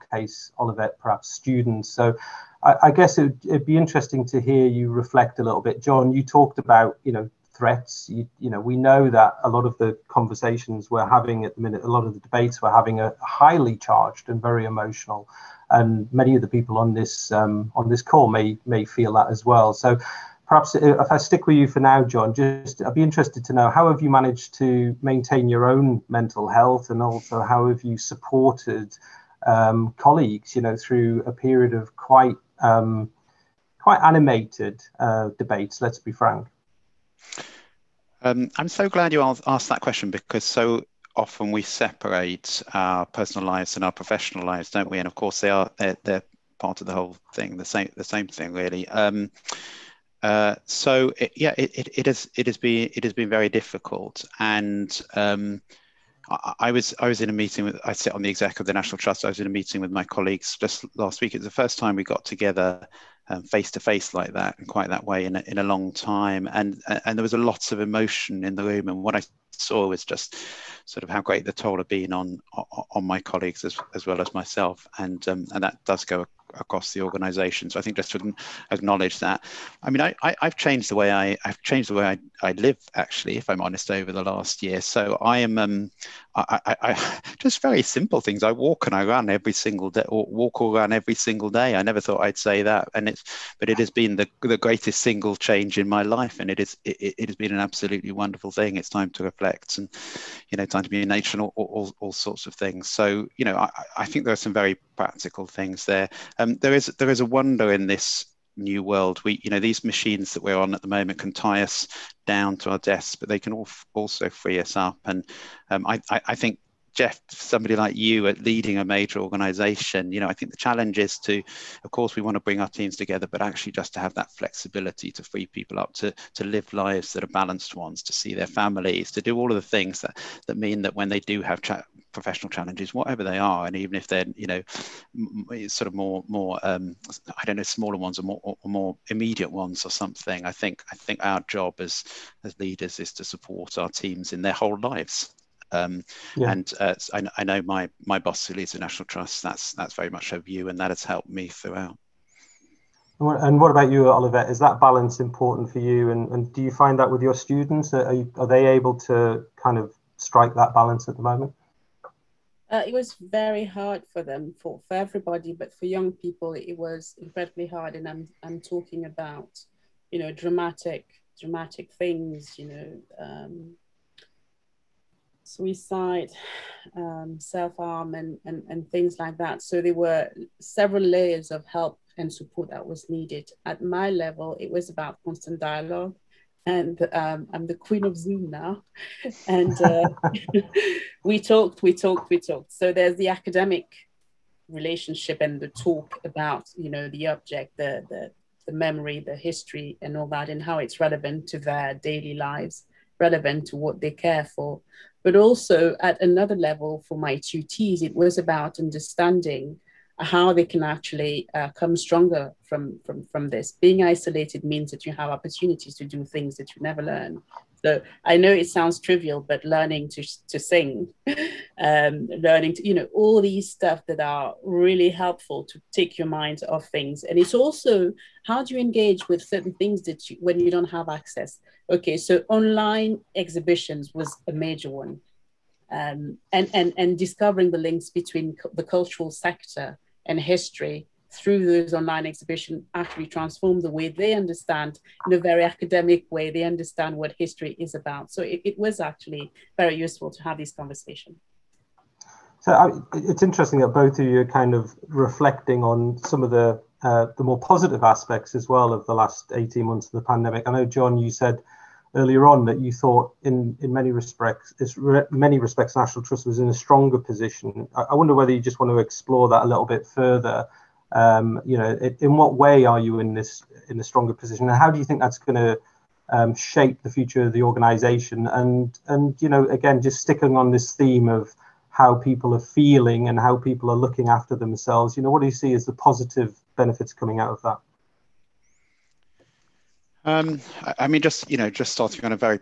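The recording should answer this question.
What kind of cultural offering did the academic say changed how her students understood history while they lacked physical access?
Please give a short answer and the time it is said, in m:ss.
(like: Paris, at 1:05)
Online exhibitions, at 3:52.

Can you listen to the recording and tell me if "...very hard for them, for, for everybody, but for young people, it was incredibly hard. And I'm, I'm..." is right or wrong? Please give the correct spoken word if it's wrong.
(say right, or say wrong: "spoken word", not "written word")
right.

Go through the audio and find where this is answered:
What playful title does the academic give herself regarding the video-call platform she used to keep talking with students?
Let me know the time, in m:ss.
3:07.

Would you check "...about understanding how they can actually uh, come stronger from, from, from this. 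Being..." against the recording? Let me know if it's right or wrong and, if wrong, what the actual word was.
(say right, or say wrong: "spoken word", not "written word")
right.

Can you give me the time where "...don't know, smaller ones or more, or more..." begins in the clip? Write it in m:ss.
2:17.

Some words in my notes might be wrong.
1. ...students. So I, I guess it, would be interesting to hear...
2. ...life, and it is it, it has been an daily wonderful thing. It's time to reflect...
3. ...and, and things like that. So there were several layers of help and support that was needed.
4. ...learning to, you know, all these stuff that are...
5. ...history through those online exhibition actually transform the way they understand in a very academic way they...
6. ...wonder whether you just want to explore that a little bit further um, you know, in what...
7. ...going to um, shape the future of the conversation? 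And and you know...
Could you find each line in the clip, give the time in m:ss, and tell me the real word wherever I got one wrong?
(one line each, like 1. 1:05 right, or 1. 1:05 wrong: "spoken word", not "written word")
1. 0:01 right
2. 1:36 wrong: "absolutely", not "daily"
3. 2:58 right
4. 3:42 right
5. 4:00 right
6. 4:28 right
7. 4:35 wrong: "organisation", not "conversation".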